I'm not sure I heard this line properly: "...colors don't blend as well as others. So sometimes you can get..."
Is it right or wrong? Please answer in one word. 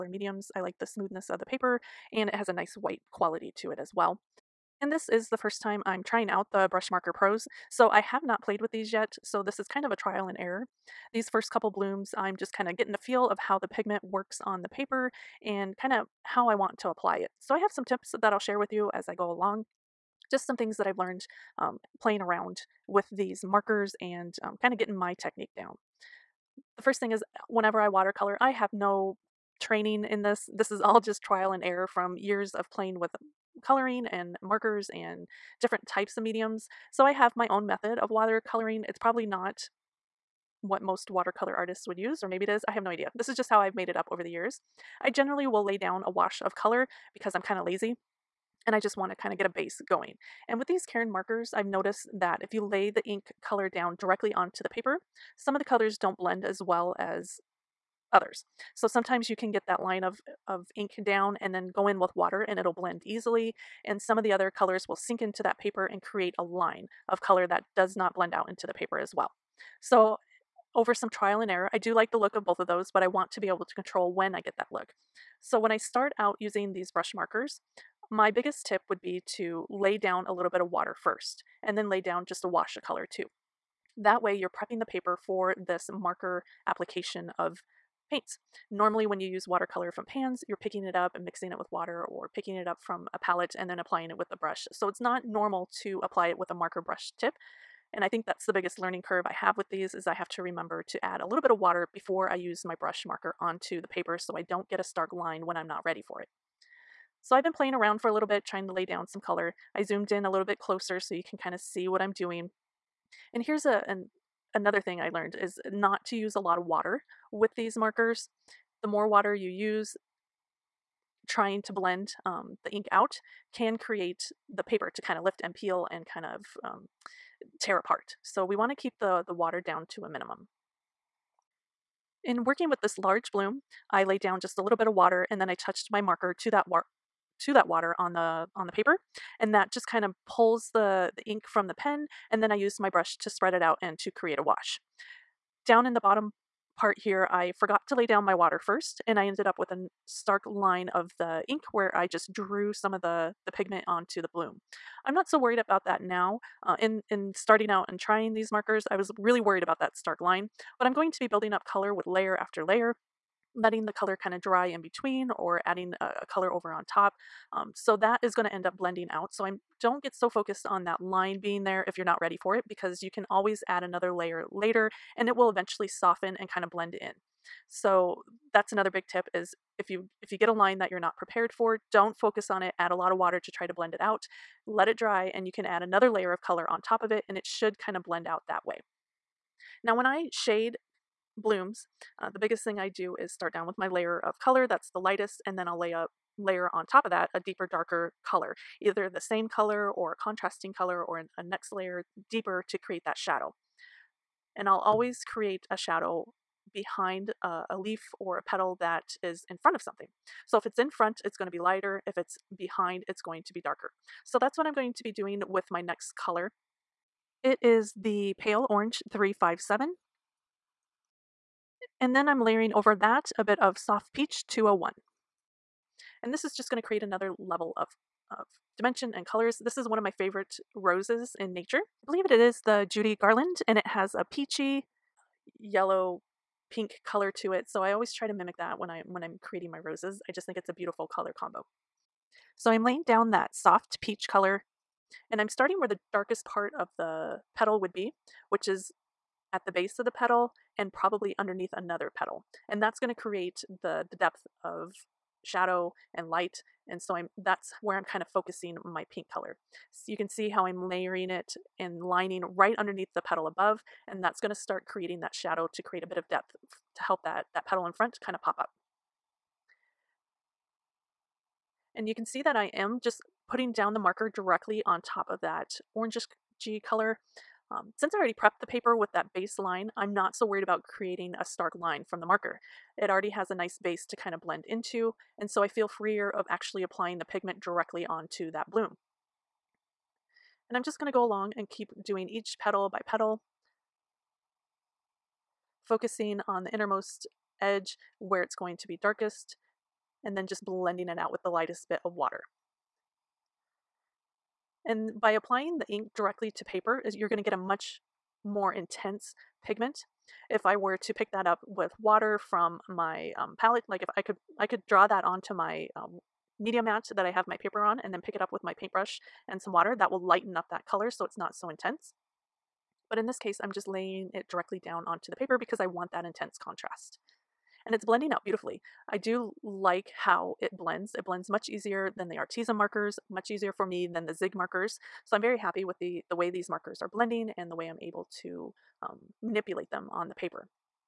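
right.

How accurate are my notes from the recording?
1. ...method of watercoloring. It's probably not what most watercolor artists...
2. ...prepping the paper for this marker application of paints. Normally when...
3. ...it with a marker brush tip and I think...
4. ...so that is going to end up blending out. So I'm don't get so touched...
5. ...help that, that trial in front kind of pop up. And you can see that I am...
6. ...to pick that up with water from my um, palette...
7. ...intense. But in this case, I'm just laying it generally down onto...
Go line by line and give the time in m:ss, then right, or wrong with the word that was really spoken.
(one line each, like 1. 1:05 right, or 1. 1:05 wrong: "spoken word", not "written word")
1. 0:37 right
2. 1:24 right
3. 1:36 right
4. 2:47 wrong: "focused", not "touched"
5. 4:27 wrong: "petal", not "trial"
6. 5:11 right
7. 5:21 wrong: "directly", not "generally".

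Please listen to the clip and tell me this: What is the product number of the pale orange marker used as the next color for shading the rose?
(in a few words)
357.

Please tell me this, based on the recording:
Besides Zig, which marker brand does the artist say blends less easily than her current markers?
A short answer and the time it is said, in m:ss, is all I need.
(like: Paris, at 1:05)
Arteza, at 5:32.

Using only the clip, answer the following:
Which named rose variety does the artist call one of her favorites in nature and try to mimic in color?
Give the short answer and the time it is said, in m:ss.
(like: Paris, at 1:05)
Judy Garland, at 3:52.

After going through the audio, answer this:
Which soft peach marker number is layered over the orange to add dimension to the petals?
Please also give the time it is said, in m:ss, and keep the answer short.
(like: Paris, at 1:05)
201, at 3:44.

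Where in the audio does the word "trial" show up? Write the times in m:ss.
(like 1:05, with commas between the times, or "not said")
0:09, 0:31, 1:11.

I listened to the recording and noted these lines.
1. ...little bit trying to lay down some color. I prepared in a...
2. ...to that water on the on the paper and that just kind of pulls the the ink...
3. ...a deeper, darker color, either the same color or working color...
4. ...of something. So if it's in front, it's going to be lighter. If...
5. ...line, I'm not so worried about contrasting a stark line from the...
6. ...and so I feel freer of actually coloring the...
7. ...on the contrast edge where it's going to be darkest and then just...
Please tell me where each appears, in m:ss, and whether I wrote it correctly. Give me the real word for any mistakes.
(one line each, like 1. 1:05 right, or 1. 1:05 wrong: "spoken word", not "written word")
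1. 1:48 wrong: "zoomed", not "prepared"
2. 2:17 right
3. 3:17 wrong: "contrasting", not "working"
4. 3:29 right
5. 4:39 wrong: "creating", not "contrasting"
6. 4:45 wrong: "applying", not "coloring"
7. 4:56 wrong: "innermost", not "contrast".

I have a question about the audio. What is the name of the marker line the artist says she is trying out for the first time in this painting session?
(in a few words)
Brush Marker Pros.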